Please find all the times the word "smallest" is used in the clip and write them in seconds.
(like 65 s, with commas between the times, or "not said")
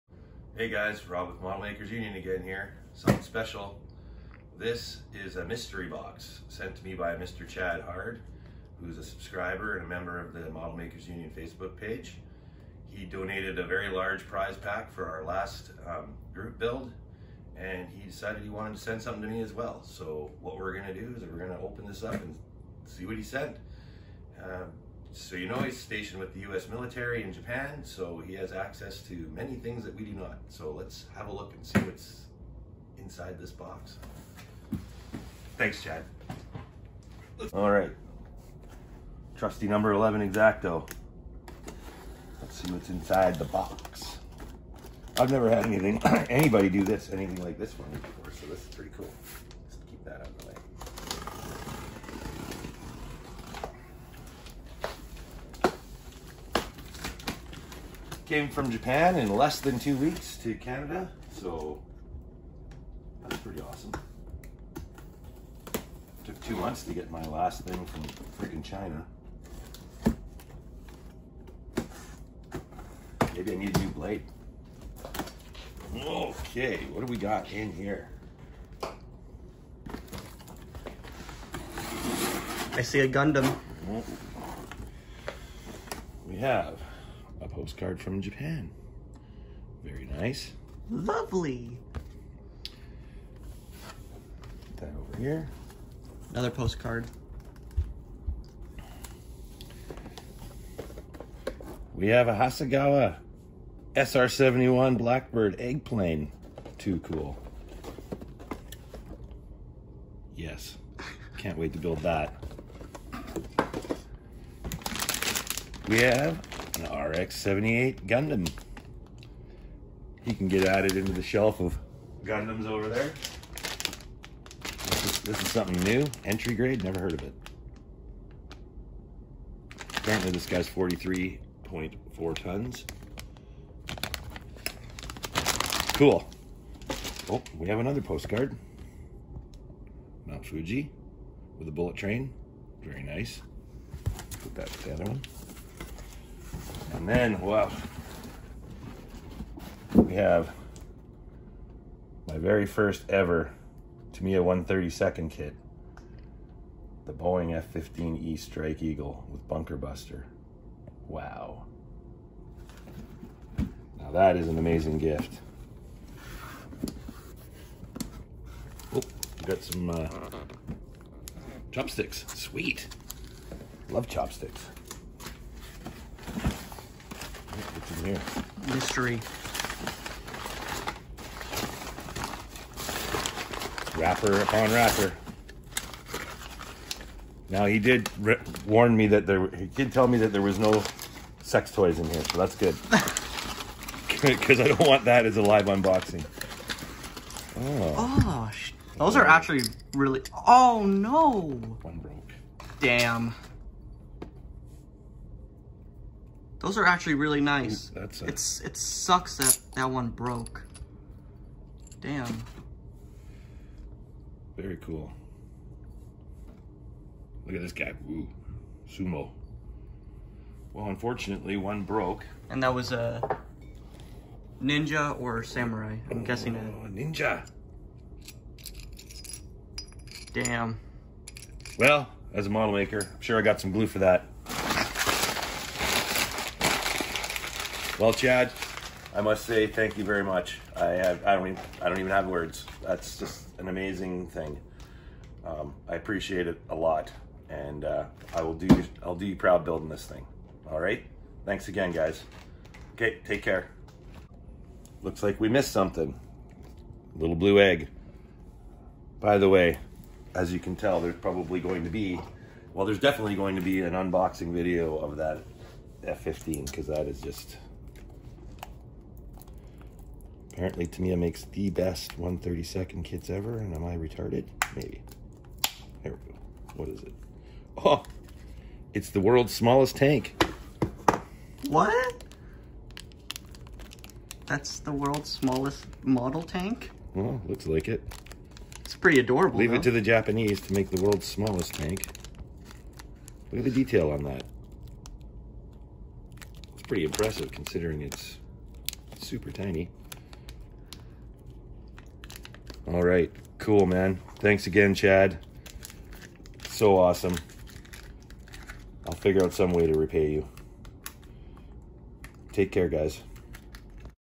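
279 s, 285 s, 291 s.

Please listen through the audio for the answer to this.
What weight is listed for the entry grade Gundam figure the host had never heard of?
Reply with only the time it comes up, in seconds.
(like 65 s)
130 s.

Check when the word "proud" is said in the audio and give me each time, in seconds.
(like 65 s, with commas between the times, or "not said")
249 s.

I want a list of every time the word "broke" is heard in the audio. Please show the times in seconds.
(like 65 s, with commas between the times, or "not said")
201 s, 210 s, 221 s.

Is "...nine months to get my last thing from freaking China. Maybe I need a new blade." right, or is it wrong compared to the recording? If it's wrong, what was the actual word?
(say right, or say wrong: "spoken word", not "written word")
wrong: "two", not "nine".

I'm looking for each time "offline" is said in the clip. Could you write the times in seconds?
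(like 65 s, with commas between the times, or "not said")
not said.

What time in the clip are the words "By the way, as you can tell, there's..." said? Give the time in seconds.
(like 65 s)
259 s.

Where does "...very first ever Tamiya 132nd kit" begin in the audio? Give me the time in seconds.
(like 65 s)
152 s.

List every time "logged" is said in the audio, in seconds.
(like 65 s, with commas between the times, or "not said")
not said.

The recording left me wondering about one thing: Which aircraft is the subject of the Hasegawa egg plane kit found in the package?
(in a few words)
SR-71 Blackbird.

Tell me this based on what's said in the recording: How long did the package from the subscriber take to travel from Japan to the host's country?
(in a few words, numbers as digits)
Less than two weeks.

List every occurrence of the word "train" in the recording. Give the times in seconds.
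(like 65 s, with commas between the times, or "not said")
141 s.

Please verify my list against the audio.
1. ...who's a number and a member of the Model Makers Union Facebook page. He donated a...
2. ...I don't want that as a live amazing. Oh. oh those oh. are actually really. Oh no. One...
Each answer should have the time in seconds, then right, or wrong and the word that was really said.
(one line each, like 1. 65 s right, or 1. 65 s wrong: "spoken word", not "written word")
1. 8 s wrong: "subscriber", not "number"
2. 194 s wrong: "unboxing", not "amazing".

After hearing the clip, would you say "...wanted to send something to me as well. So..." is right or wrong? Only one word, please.
right.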